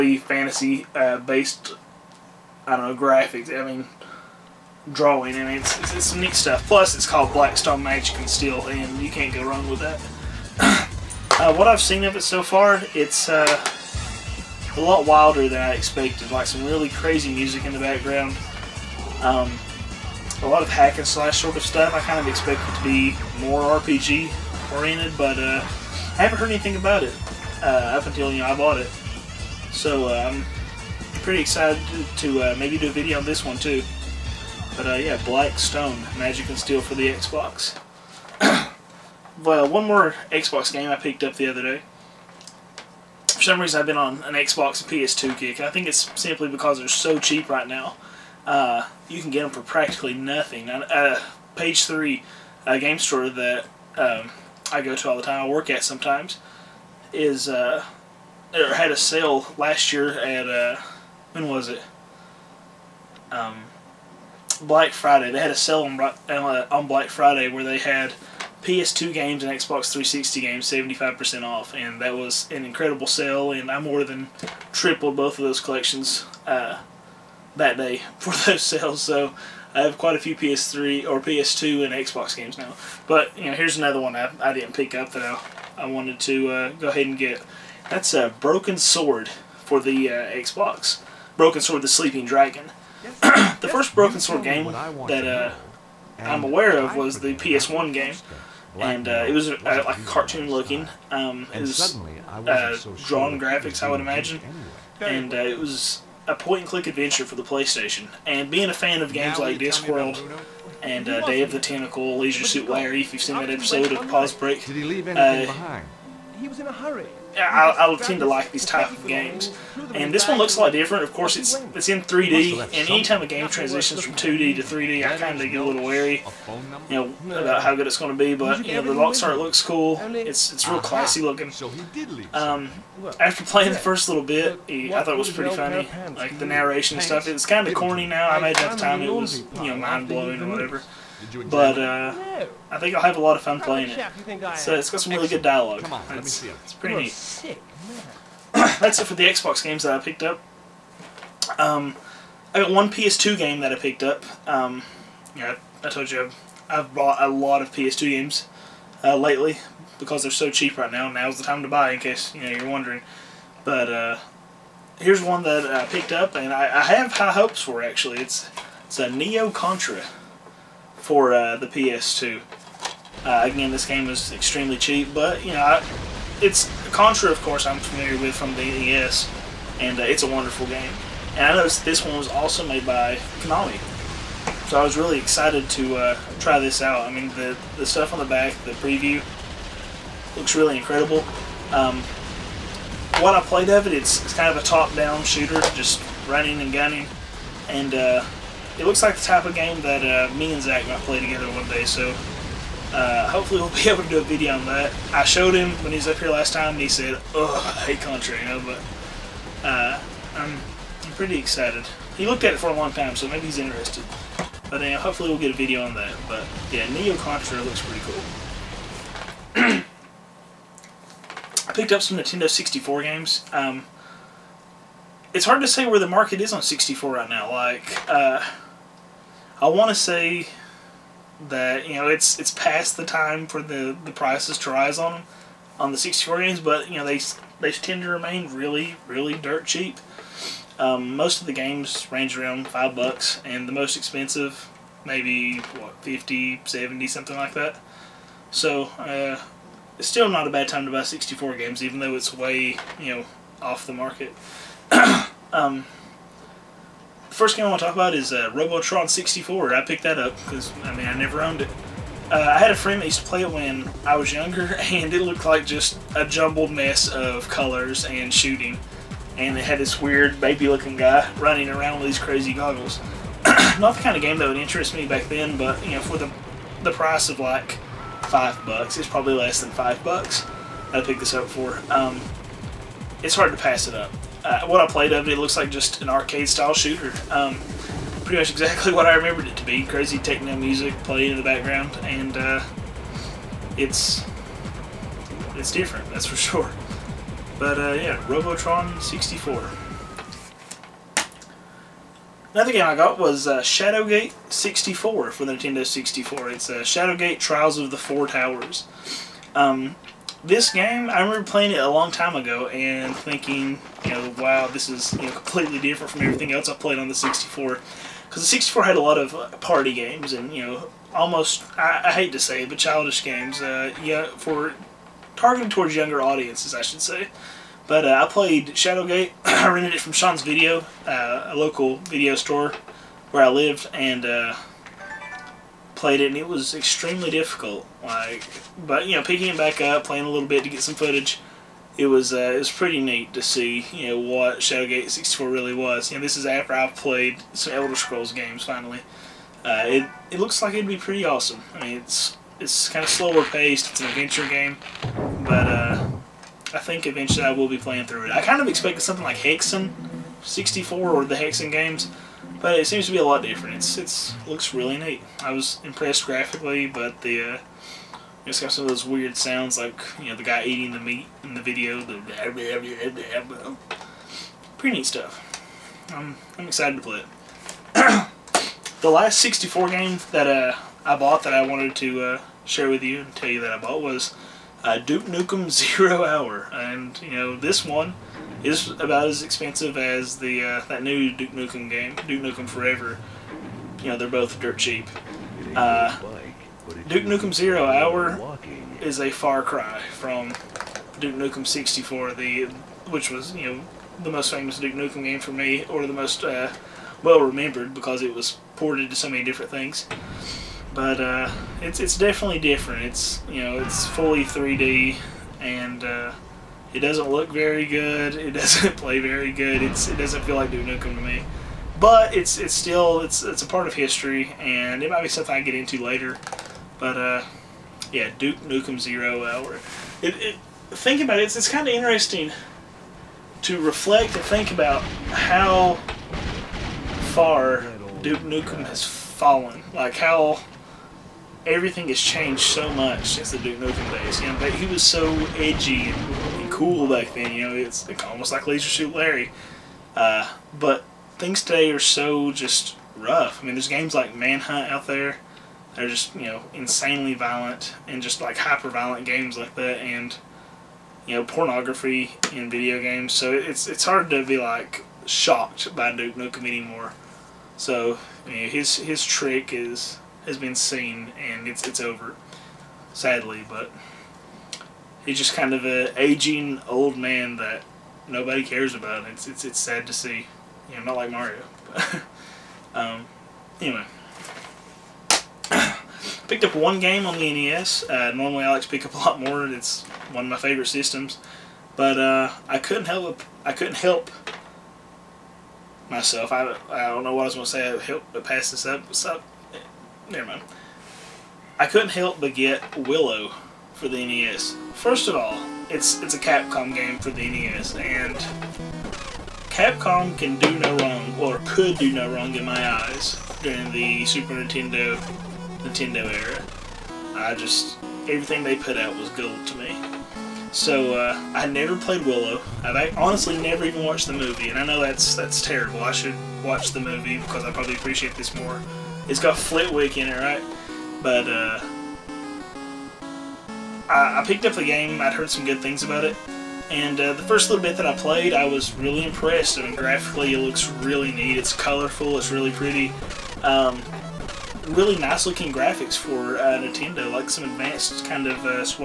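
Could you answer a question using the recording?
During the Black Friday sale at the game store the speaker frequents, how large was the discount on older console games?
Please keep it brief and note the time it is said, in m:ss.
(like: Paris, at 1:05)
75%, at 1:10.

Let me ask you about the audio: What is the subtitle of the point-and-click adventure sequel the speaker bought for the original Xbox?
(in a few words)
The Sleeping Dragon.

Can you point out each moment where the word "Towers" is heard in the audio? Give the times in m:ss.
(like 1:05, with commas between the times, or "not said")
5:08.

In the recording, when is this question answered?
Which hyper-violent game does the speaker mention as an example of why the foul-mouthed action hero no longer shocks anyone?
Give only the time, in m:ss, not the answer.
7:34.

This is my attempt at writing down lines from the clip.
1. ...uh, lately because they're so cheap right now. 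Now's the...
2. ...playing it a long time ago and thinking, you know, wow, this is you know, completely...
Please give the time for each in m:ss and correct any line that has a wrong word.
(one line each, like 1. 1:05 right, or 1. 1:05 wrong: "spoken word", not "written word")
1. 2:39 right
2. 5:11 right.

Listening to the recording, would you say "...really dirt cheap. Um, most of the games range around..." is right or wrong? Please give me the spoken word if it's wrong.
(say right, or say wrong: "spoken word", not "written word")
right.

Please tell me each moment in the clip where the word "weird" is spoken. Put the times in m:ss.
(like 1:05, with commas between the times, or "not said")
4:29, 6:09.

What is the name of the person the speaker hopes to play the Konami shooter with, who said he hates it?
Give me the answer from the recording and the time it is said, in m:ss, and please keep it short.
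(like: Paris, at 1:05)
Zach, at 3:20.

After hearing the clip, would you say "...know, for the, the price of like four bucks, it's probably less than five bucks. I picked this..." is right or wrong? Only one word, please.
wrong.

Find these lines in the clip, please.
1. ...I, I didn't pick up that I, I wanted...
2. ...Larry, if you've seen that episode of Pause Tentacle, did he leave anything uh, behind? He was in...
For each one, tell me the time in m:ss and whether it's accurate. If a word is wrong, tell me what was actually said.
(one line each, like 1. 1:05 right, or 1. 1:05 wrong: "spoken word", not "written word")
1. 1:24 right
2. 1:52 wrong: "Break", not "Tentacle".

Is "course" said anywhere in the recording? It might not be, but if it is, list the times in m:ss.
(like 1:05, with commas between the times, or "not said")
2:01, 2:57.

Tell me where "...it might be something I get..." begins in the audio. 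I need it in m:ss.
7:05.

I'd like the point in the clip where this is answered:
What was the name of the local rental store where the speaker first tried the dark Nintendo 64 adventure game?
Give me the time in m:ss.
5:30.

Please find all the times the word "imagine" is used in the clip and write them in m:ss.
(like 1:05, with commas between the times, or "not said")
1:43, 2:18.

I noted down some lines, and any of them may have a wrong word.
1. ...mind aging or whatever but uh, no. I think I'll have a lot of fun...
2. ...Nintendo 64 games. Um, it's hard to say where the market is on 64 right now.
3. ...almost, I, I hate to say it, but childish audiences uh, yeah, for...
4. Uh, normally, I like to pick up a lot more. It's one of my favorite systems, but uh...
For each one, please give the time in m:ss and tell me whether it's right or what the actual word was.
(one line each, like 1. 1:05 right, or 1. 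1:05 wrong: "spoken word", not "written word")
1. 2:19 wrong: "blowing", not "aging"
2. 3:42 right
3. 5:21 wrong: "games", not "audiences"
4. 8:08 right.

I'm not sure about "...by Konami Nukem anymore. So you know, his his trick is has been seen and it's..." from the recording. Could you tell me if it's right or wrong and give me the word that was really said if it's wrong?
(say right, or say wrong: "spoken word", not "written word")
wrong: "Duke", not "Konami".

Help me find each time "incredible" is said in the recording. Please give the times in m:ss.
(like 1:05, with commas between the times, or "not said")
1:12, 3:10.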